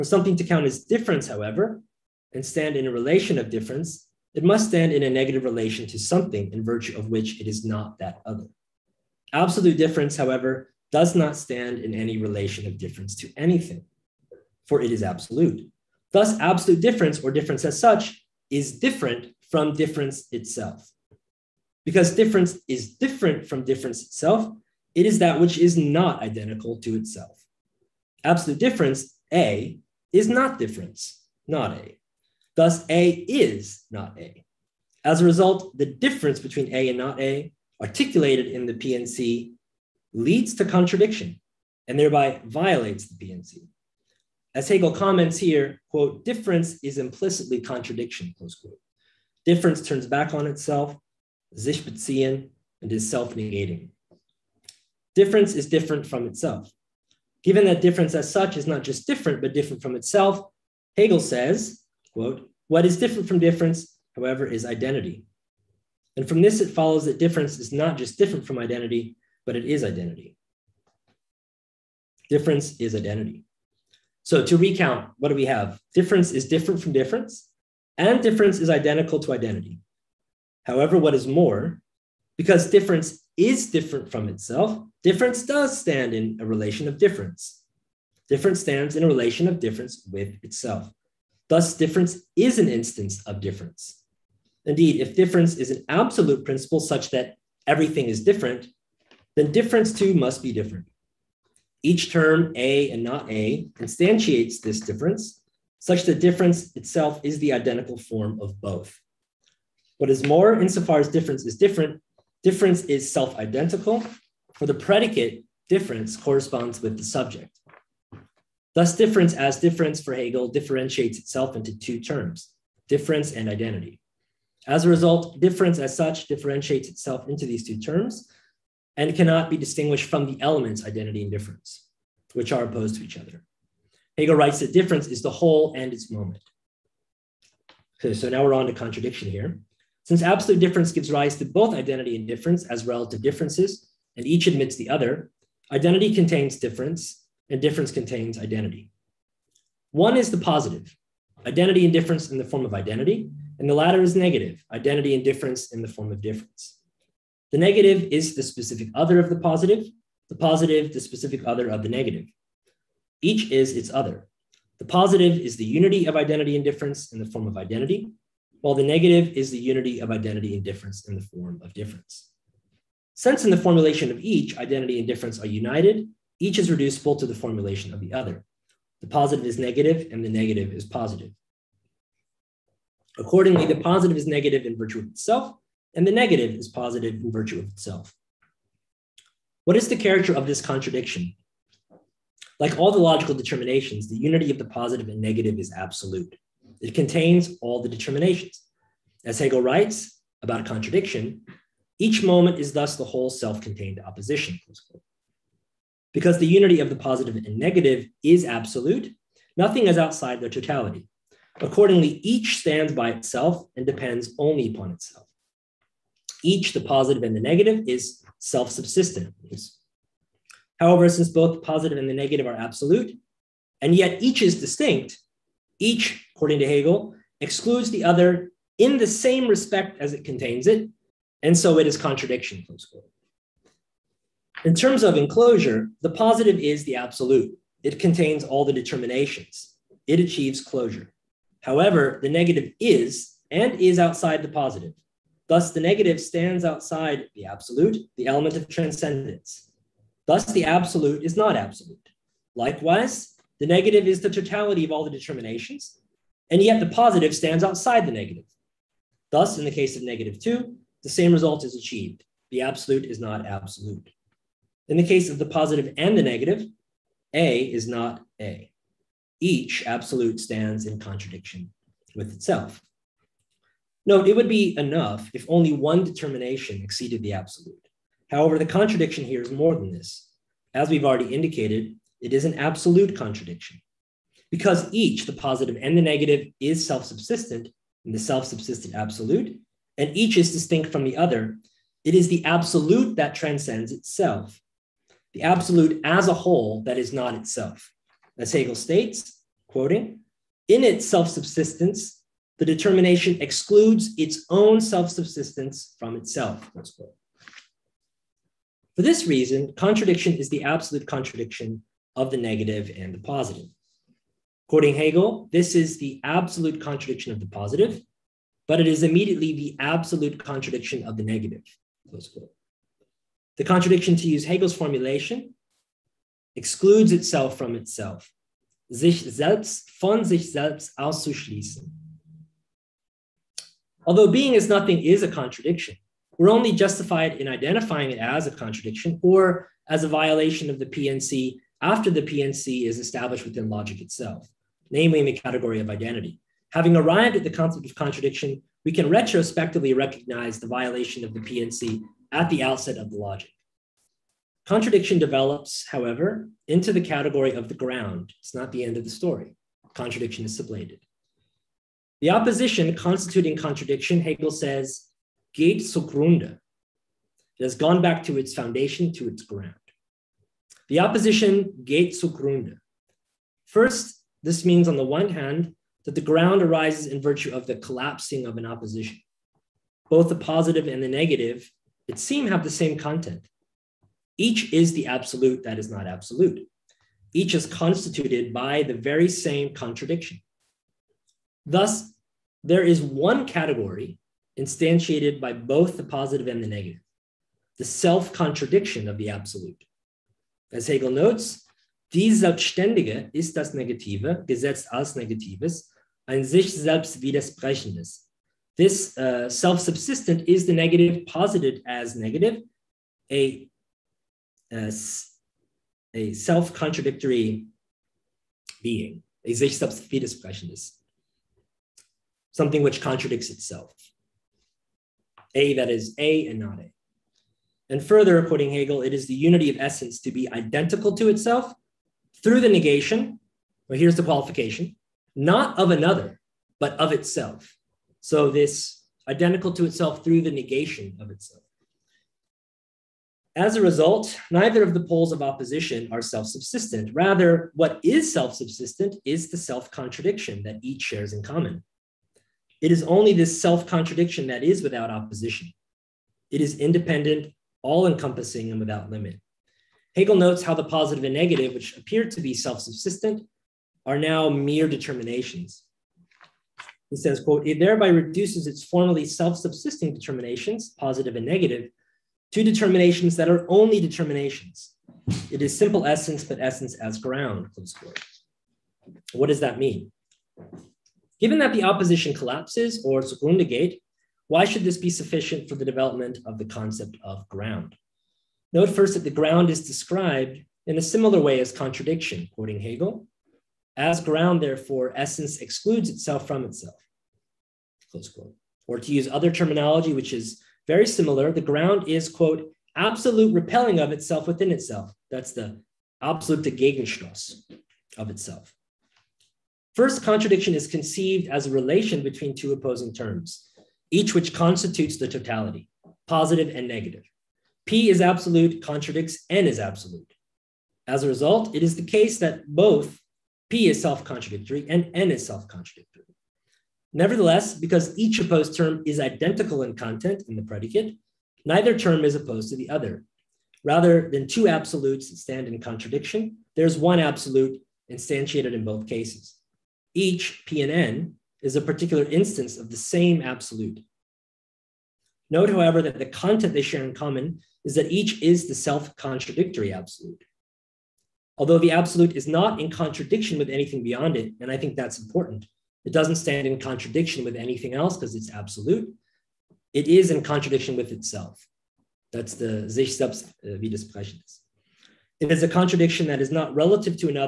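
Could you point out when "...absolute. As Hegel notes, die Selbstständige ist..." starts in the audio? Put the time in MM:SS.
06:39.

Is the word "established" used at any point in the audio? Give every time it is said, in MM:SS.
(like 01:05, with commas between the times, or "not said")
05:42.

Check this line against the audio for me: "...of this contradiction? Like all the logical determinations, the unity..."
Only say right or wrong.
right.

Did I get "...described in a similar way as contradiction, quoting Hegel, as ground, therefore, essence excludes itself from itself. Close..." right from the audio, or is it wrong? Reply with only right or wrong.
right.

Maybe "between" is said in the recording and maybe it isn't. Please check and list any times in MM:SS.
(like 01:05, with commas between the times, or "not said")
00:36, 08:32.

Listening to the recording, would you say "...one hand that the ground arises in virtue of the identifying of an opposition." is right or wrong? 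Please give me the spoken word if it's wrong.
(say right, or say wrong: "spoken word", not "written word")
wrong: "collapsing", not "identifying".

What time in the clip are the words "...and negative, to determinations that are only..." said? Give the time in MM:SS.
07:51.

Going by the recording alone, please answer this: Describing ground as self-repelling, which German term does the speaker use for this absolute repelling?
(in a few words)
Gegenstoß.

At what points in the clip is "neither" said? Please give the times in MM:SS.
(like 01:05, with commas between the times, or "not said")
07:24, 08:51.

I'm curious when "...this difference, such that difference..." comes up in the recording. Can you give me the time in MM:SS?
01:44.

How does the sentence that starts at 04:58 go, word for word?
As Hegel states, quoting, in its self subsistence, the determination excludes its own self subsistence from itself.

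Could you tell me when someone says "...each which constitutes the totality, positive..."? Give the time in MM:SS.
08:34.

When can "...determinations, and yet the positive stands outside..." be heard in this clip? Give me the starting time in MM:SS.
04:15.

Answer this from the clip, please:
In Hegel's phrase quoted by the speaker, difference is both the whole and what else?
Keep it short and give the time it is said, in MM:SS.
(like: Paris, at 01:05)
its moment, at 02:15.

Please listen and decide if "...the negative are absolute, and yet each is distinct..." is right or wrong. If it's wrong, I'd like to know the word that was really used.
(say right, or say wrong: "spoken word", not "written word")
right.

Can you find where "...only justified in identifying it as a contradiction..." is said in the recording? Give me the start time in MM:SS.
05:36.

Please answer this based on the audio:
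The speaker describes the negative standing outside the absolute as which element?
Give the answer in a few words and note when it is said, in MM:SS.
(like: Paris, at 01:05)
transcendence, at 04:08.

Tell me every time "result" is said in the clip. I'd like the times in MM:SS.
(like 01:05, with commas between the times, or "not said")
00:35, 02:04, 04:21, 07:23, 08:41.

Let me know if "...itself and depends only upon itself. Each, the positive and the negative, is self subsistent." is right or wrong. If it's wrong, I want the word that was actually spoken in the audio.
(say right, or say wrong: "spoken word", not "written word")
right.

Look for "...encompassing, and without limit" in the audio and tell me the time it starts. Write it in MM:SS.
07:38.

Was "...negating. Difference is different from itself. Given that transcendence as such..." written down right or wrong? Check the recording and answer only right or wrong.
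wrong.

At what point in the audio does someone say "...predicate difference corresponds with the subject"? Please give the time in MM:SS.
01:54.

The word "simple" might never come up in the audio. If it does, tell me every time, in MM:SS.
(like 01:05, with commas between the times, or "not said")
07:55.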